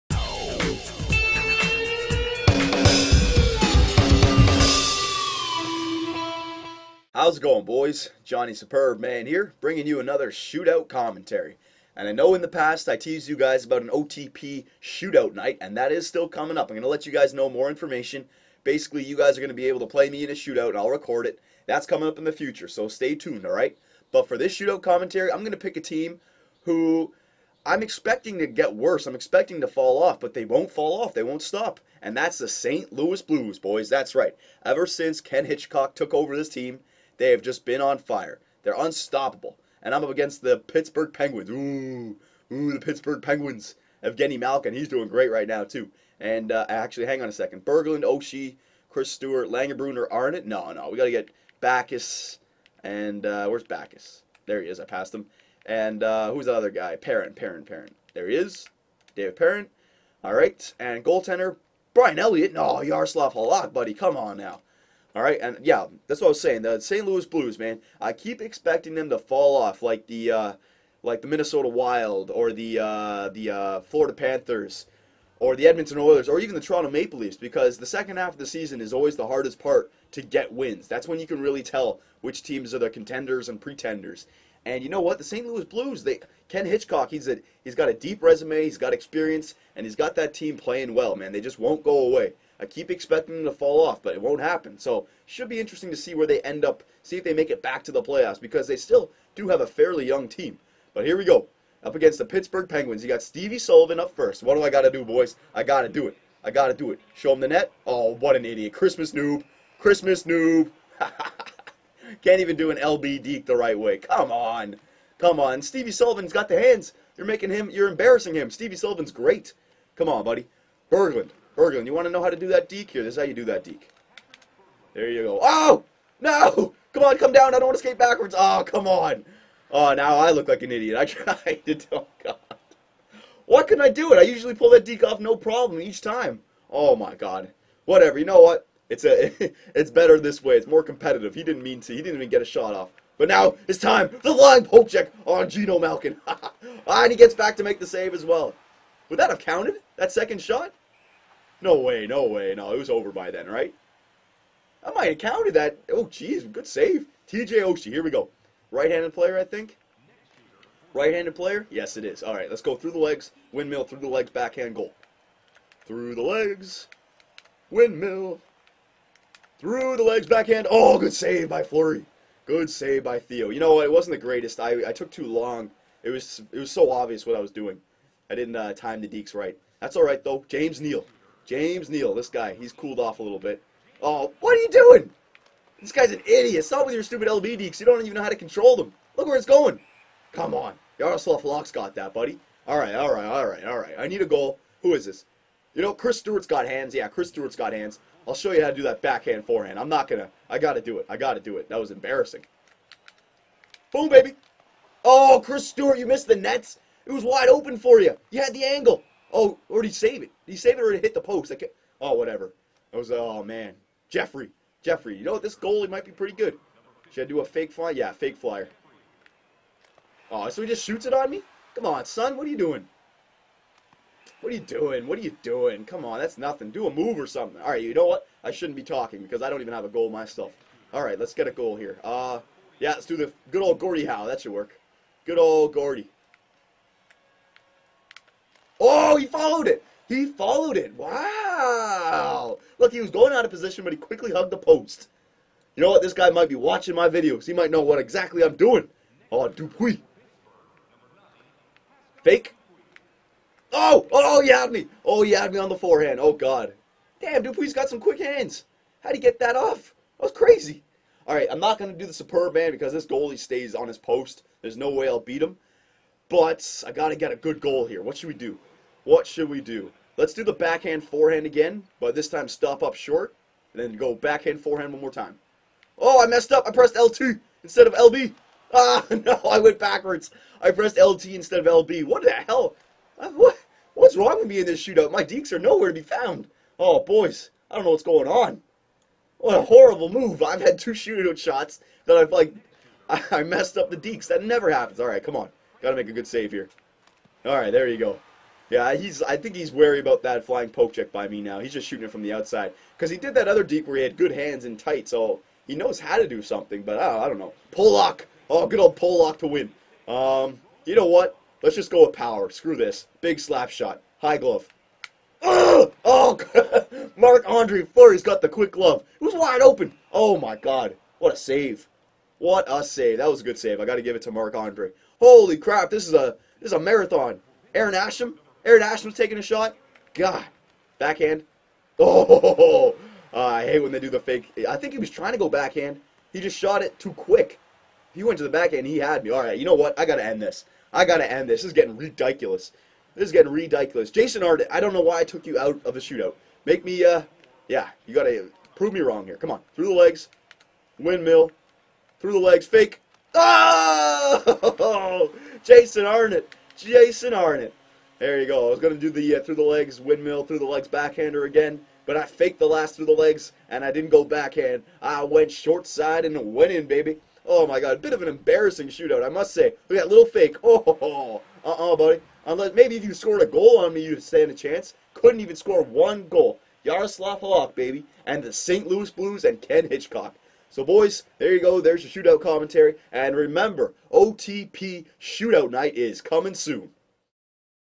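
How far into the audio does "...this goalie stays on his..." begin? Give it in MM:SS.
04:22.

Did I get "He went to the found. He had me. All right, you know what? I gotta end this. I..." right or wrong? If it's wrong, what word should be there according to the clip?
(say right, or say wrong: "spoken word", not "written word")
wrong: "backhand", not "found".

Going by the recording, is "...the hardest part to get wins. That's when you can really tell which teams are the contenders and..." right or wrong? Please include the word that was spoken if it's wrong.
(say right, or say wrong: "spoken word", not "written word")
right.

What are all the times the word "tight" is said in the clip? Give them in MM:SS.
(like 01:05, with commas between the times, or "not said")
05:04.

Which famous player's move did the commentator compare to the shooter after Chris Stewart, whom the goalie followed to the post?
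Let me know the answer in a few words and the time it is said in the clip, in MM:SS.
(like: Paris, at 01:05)
Gordie Howe, at 03:53.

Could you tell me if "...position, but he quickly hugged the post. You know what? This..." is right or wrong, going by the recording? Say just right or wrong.
right.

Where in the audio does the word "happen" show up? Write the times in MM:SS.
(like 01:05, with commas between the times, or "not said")
01:34, 04:54.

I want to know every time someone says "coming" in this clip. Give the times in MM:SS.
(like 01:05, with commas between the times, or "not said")
00:16, 00:21, 06:26.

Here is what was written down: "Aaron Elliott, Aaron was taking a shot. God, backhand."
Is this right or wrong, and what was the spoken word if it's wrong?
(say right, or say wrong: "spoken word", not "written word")
wrong: "Asham", not "Elliott".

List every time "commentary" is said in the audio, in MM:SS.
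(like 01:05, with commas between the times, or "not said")
00:10, 00:24, 06:22.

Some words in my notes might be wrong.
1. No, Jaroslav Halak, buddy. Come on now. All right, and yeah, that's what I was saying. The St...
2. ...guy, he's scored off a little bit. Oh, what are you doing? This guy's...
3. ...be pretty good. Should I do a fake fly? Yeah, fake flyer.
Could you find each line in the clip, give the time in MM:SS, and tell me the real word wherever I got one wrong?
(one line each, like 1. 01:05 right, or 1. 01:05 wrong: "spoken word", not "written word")
1. 01:02 right
2. 03:02 wrong: "cooled", not "scored"
3. 03:36 right.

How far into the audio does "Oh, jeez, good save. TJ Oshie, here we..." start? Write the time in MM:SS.
02:35.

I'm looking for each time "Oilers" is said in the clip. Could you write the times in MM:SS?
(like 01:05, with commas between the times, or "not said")
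01:15.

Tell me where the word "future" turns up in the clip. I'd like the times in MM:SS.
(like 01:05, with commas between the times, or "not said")
00:22.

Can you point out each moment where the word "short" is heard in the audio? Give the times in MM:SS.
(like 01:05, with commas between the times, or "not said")
04:32, 06:05.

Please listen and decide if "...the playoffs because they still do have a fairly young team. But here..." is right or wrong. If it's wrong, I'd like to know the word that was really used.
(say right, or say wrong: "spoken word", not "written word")
right.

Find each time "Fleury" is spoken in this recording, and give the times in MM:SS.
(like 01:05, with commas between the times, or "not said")
02:51, 05:17.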